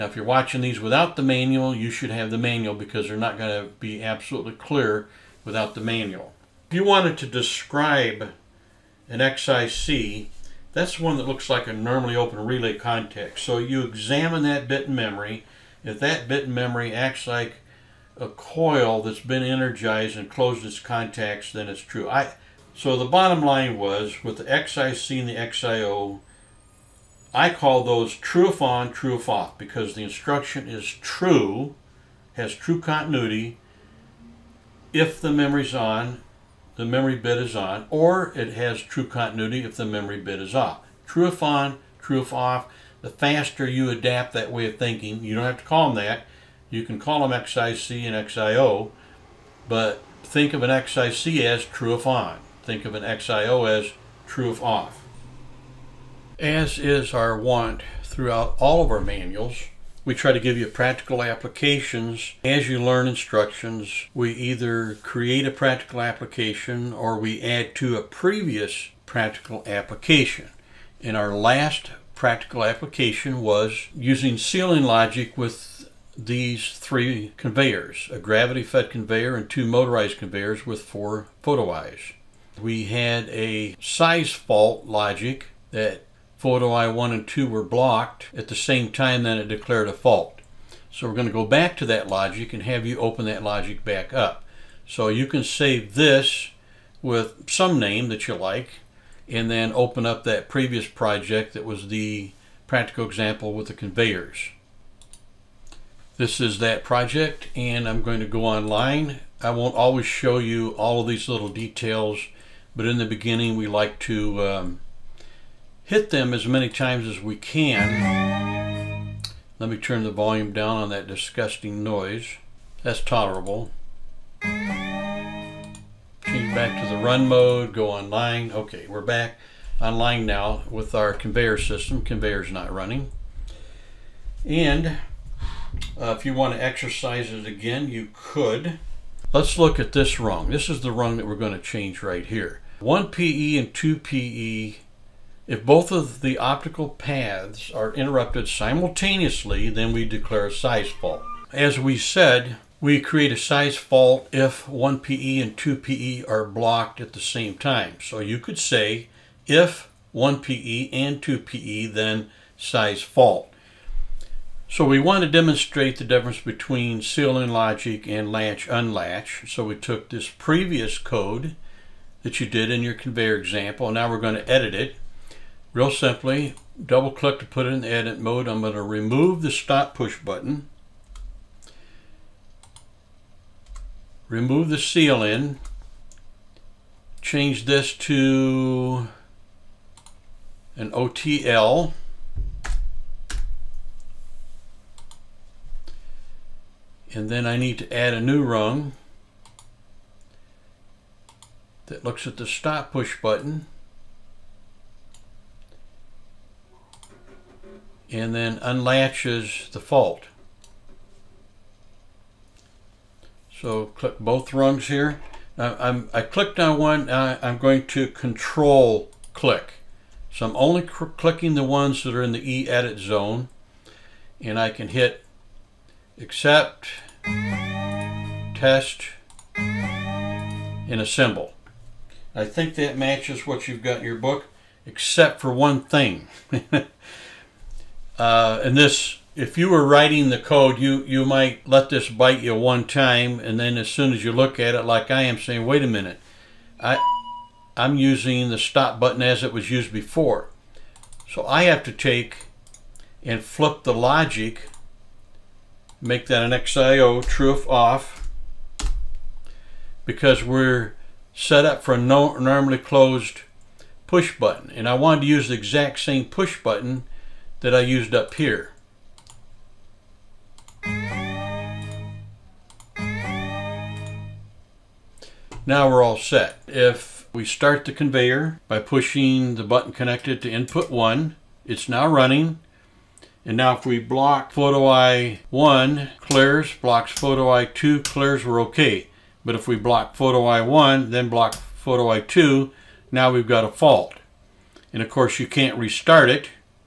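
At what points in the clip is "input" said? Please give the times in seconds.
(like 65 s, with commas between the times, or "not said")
280 s.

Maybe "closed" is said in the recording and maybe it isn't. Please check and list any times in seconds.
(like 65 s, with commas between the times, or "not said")
20 s, 262 s.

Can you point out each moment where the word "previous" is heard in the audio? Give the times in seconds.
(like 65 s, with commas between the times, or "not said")
68 s, 100 s, 170 s.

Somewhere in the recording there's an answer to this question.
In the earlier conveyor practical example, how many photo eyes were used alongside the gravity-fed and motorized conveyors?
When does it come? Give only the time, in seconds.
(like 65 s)
80 s.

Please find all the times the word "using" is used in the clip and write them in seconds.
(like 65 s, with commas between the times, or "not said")
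73 s, 247 s.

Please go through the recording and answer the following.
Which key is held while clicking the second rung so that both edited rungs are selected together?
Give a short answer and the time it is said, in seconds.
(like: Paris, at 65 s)
Control, at 218 s.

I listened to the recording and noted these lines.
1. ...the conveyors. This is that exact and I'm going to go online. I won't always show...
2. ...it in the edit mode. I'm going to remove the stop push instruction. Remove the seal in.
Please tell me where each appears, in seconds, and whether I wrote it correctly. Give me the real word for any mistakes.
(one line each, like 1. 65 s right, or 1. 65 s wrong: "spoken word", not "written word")
1. 103 s wrong: "project", not "exact"
2. 177 s wrong: "button", not "instruction".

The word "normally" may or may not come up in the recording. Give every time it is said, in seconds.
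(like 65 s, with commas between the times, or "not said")
11 s, 262 s.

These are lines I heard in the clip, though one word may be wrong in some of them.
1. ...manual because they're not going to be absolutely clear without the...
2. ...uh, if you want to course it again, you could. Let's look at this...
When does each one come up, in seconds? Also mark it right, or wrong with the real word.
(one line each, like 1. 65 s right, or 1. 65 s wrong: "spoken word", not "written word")
1. 2 s right
2. 135 s wrong: "exercise", not "course".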